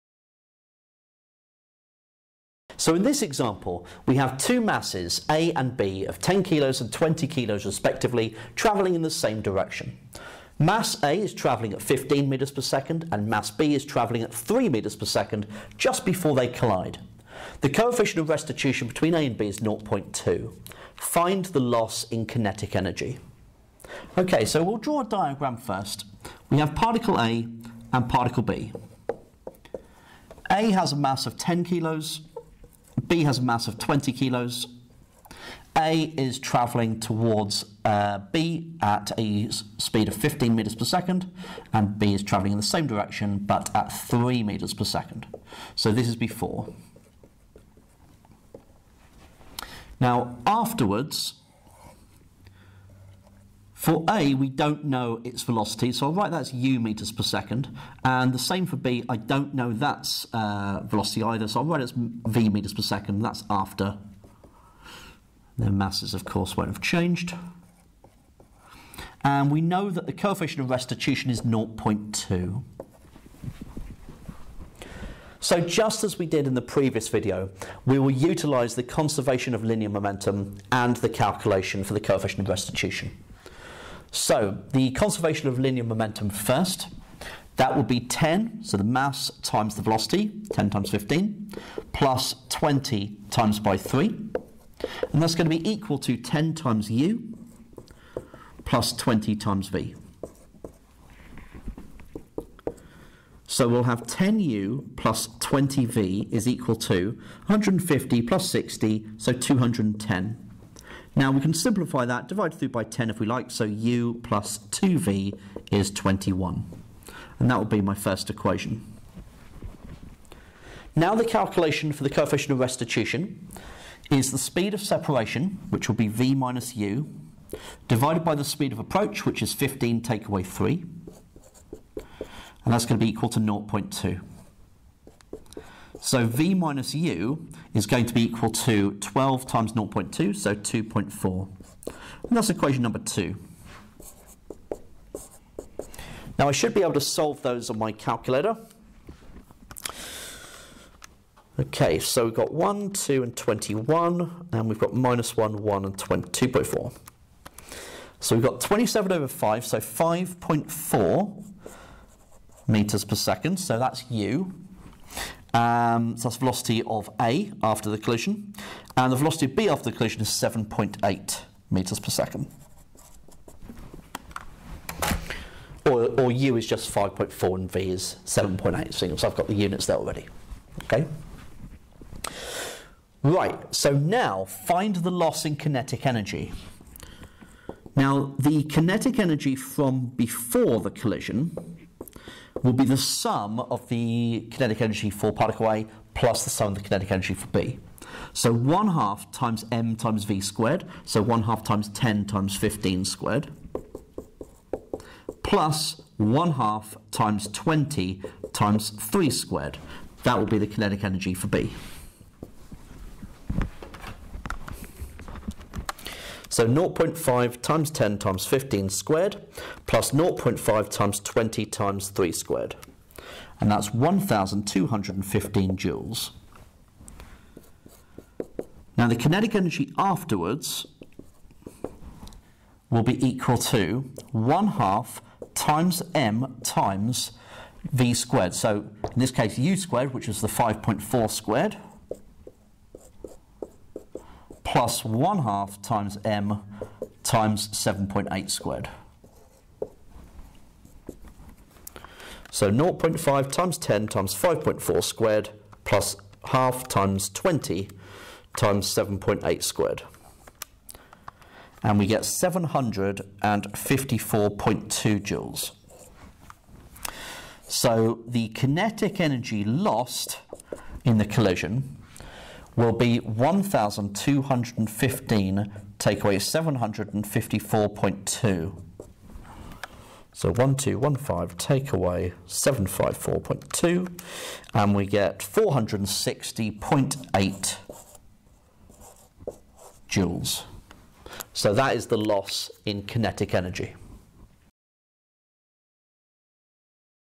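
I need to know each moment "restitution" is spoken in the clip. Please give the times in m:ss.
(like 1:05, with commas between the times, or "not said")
0:18, 1:10, 1:22, 2:02.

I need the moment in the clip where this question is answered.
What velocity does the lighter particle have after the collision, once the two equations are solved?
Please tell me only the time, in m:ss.
2:39.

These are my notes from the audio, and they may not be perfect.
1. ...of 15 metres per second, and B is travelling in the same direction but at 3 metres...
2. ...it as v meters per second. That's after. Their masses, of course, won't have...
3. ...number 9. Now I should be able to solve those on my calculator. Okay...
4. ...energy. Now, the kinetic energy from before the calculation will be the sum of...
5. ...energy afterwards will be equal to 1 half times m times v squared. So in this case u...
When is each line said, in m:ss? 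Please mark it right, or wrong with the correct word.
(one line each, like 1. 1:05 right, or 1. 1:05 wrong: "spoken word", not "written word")
1. 0:40 right
2. 1:01 right
3. 2:22 wrong: "2", not "9"
4. 3:06 wrong: "collision", not "calculation"
5. 3:49 right.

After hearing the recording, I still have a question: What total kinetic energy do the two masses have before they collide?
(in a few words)
1,215 joules.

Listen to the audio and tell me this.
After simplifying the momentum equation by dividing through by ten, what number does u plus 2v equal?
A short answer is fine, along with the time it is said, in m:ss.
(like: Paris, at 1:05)
21, at 1:53.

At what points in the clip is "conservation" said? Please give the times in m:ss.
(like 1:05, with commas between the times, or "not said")
1:18, 1:24.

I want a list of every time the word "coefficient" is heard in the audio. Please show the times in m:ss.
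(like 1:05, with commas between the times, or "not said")
0:17, 1:10, 1:21, 2:02.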